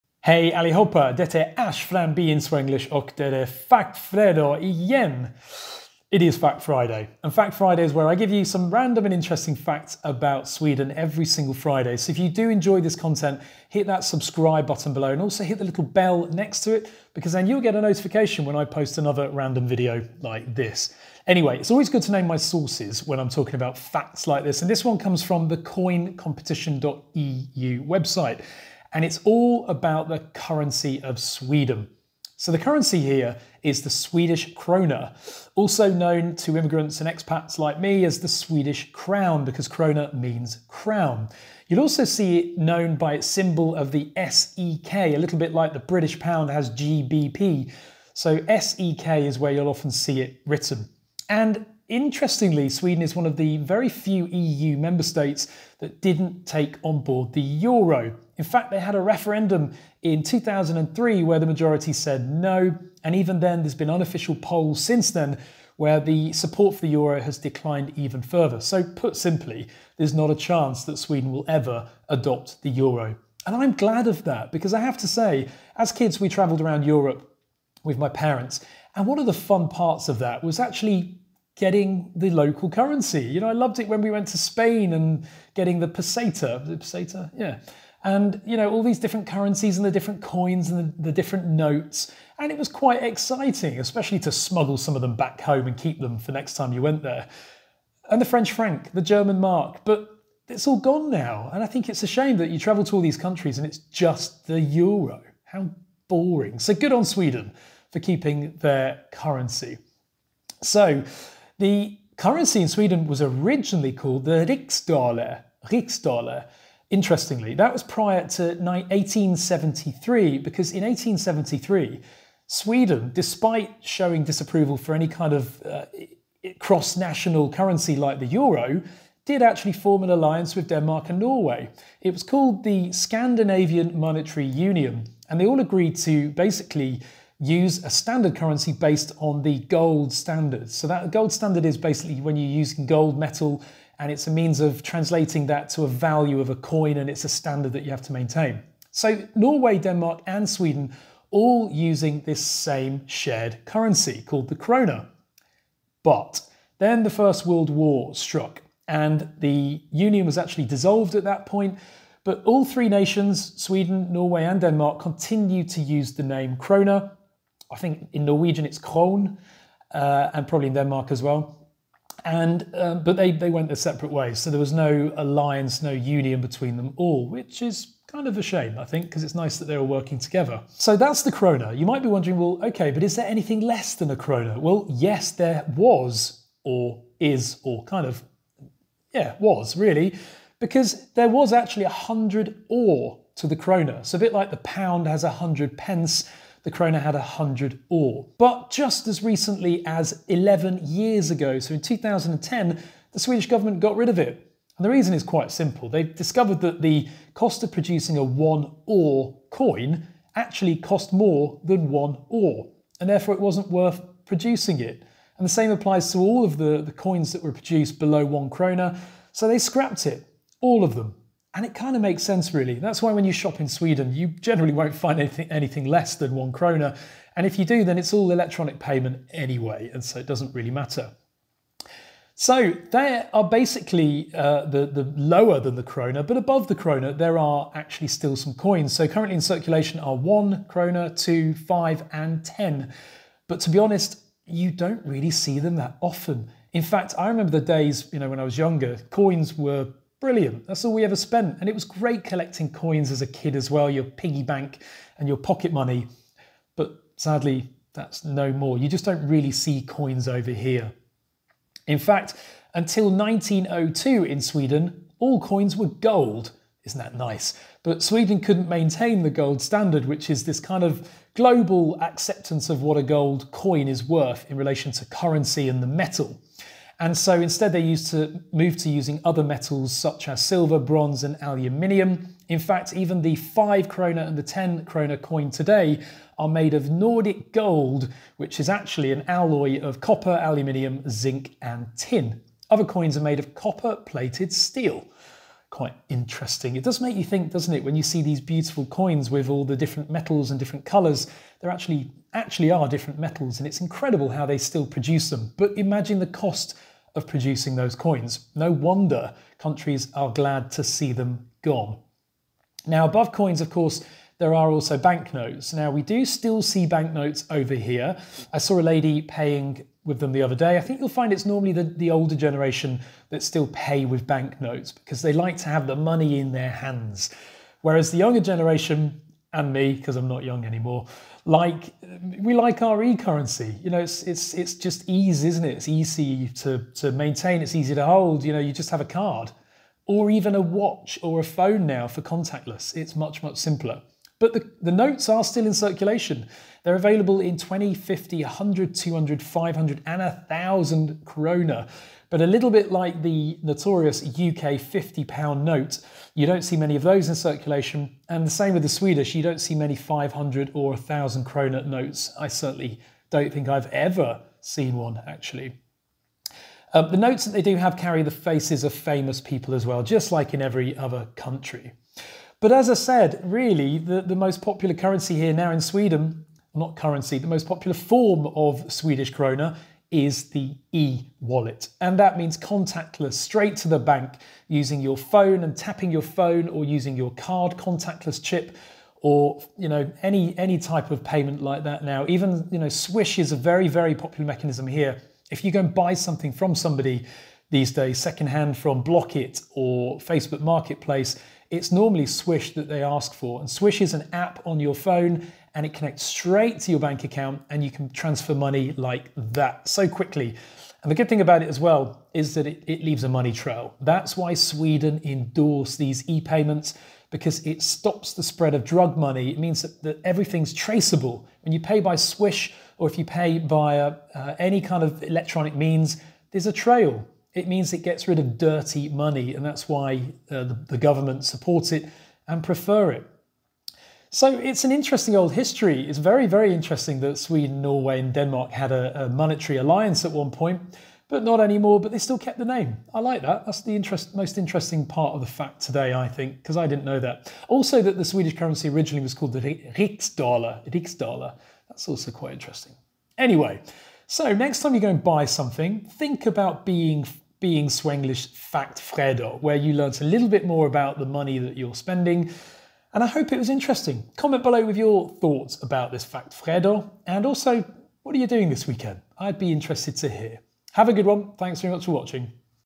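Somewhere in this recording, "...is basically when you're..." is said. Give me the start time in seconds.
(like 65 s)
141 s.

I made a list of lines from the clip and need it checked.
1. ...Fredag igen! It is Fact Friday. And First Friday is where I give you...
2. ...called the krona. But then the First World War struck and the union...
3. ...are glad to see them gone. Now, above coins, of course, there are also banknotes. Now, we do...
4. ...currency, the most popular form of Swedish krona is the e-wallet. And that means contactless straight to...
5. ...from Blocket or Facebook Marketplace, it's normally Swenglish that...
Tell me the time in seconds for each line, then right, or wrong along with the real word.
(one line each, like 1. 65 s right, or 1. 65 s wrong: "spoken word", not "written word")
1. 3 s wrong: "Fact", not "First"
2. 154 s right
3. 310 s right
4. 376 s right
5. 398 s wrong: "Swish", not "Swenglish".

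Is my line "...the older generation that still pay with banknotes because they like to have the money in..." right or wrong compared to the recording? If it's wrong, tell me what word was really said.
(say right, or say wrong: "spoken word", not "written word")
right.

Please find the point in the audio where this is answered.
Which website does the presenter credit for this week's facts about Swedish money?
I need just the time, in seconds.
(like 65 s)
25 s.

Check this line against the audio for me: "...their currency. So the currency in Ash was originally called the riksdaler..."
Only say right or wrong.
wrong.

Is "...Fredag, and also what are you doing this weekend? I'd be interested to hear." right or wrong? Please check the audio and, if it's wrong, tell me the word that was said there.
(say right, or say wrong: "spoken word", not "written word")
right.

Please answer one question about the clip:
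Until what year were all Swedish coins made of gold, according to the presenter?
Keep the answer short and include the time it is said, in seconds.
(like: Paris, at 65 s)
1902, at 263 s.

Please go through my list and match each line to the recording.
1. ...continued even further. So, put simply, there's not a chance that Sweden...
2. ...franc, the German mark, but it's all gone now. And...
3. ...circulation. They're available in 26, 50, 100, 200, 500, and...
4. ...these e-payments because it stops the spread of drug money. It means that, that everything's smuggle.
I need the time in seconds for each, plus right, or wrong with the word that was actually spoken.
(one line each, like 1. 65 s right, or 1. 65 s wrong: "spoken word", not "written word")
1. 67 s wrong: "declined", not "continued"
2. 98 s right
3. 345 s wrong: "20", not "26"
4. 415 s wrong: "traceable", not "smuggle".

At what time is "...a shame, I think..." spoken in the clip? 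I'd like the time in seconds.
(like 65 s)
178 s.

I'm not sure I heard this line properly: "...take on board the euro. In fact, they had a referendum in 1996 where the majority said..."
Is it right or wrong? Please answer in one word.
wrong.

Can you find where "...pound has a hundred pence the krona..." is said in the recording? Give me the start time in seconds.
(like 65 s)
194 s.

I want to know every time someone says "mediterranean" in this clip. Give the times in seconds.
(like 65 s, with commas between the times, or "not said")
not said.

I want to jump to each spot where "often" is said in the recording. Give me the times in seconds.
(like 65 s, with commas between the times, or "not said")
49 s, 246 s.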